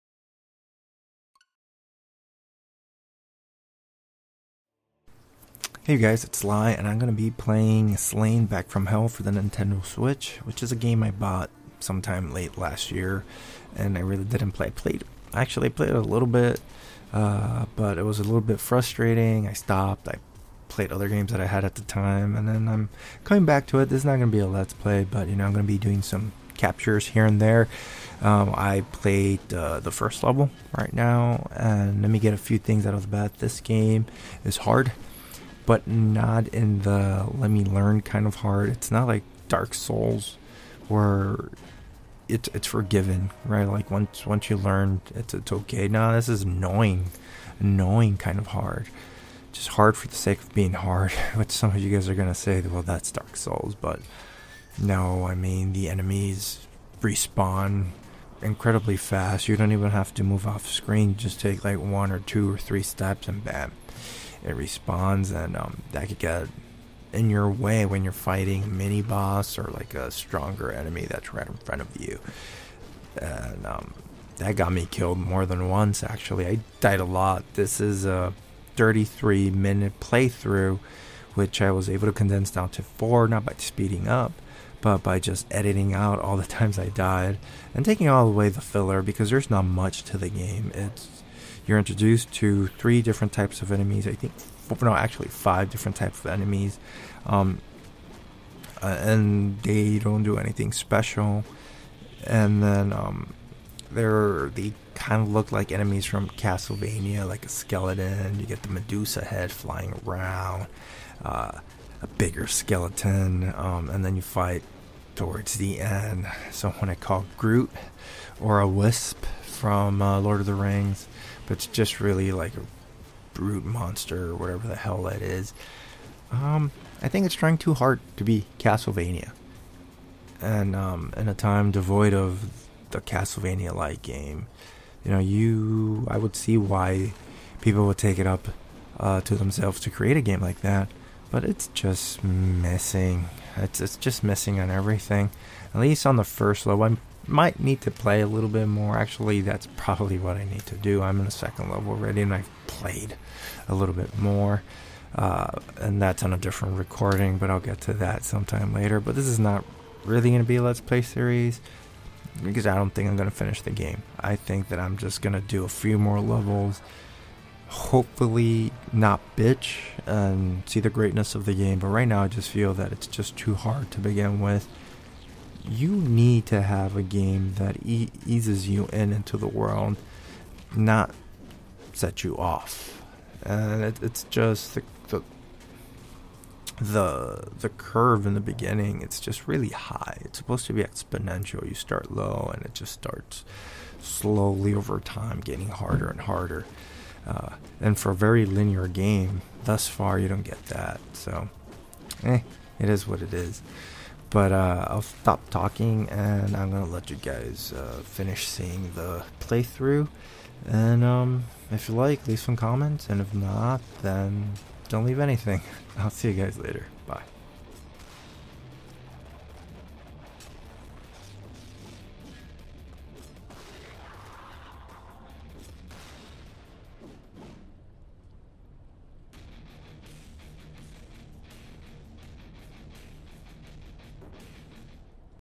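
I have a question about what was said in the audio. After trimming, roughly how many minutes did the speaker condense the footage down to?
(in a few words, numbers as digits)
4.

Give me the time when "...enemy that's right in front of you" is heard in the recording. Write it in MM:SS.
01:10.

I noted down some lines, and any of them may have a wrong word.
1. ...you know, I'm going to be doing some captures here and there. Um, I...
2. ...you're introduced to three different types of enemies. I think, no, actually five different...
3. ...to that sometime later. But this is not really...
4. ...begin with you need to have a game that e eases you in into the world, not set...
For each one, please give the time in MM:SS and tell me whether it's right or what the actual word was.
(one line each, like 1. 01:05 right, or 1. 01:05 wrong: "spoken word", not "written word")
1. 00:25 right
2. 01:31 right
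3. 02:37 right
4. 02:53 right.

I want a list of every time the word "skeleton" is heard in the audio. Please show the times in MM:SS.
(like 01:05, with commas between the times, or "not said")
01:47, 01:52.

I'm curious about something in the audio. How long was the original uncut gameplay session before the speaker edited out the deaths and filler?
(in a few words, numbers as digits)
33 minutes.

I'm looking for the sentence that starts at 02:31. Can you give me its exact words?
I'm in a second level already, and I've played a little bit more.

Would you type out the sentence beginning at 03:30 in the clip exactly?
And um, if you like, leave some comments.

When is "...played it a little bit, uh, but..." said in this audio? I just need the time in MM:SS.
00:15.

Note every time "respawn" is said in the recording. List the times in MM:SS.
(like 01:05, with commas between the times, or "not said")
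00:57, 01:04.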